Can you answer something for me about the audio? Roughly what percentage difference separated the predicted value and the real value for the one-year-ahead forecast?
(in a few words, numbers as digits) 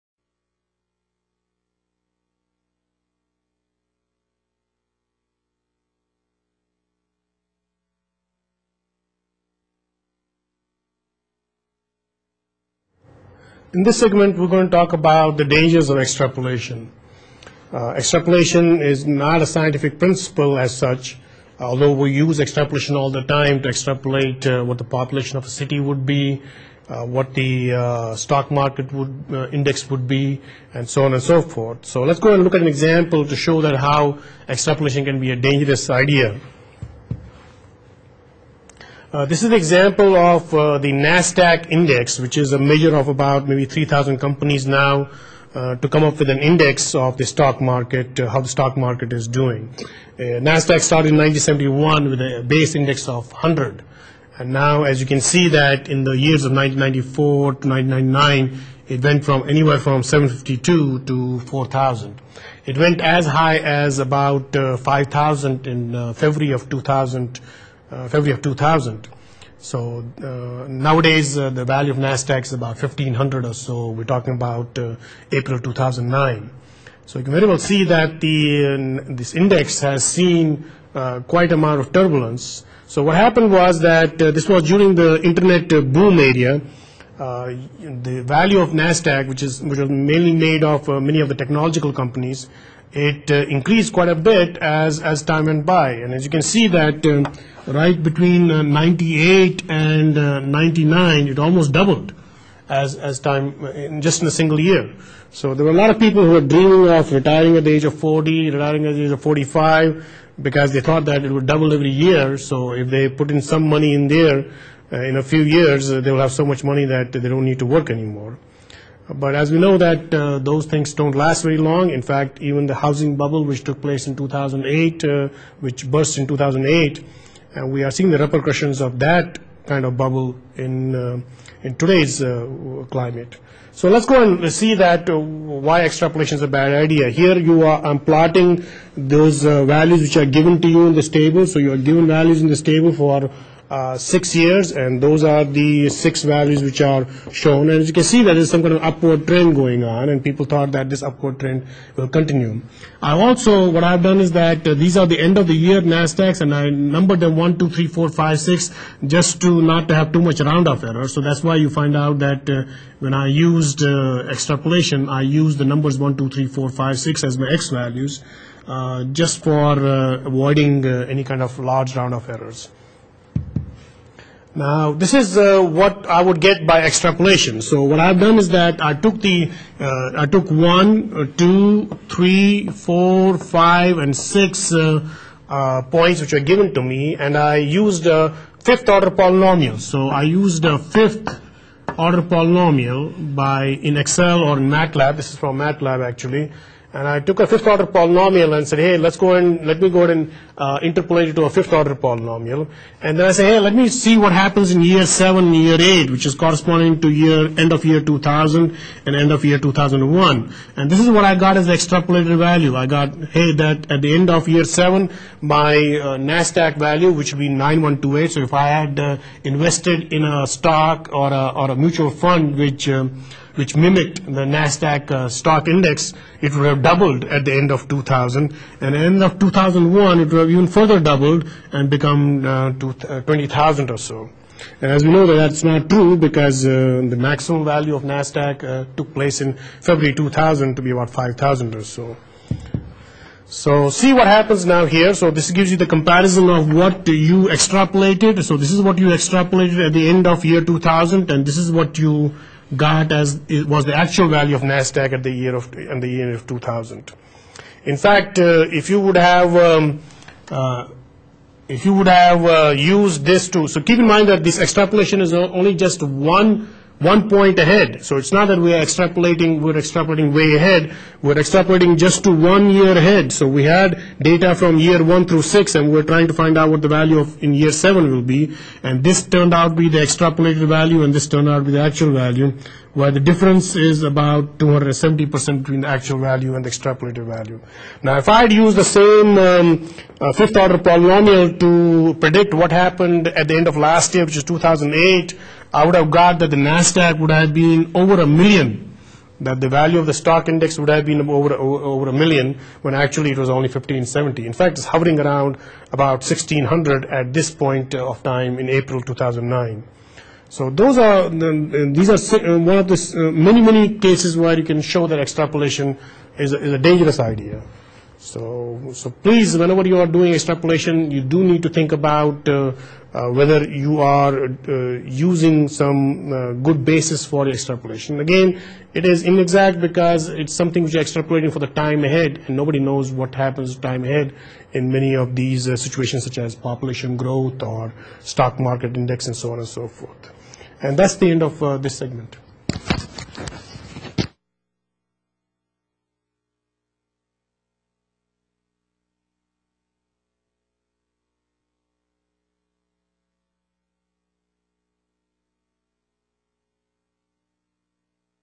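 270%.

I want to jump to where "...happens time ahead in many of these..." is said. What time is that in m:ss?
5:33.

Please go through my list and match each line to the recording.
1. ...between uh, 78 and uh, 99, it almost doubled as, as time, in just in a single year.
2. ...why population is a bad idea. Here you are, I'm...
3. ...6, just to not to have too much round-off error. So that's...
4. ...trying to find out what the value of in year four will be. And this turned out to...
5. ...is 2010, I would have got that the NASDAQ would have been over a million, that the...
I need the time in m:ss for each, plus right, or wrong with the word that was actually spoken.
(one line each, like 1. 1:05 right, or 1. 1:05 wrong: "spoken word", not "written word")
1. 1:38 wrong: "98", not "78"
2. 2:15 wrong: "extrapolation", not "population"
3. 2:38 right
4. 4:36 wrong: "seven", not "four"
5. 4:54 wrong: "2008", not "2010".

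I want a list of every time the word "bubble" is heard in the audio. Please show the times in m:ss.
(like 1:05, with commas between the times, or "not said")
2:03, 2:09.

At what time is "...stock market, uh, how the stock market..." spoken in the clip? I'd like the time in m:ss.
0:47.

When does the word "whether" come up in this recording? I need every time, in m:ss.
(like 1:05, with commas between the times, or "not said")
5:23.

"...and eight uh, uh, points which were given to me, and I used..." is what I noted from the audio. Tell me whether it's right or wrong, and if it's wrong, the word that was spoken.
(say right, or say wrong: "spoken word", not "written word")
wrong: "six", not "eight".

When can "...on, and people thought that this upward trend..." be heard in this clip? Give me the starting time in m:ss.
2:29.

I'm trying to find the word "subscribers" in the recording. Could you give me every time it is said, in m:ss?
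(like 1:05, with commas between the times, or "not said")
not said.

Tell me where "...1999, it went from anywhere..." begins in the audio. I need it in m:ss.
0:57.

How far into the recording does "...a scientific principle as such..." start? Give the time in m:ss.
0:19.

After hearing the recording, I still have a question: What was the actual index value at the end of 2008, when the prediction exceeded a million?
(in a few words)
1570.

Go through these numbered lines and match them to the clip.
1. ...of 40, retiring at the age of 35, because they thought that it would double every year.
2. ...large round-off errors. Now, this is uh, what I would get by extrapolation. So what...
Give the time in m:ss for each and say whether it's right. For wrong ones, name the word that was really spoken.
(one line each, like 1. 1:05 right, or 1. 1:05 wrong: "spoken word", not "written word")
1. 1:47 wrong: "45", not "35"
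2. 2:51 right.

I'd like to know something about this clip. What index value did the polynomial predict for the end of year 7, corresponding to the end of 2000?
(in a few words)
9128.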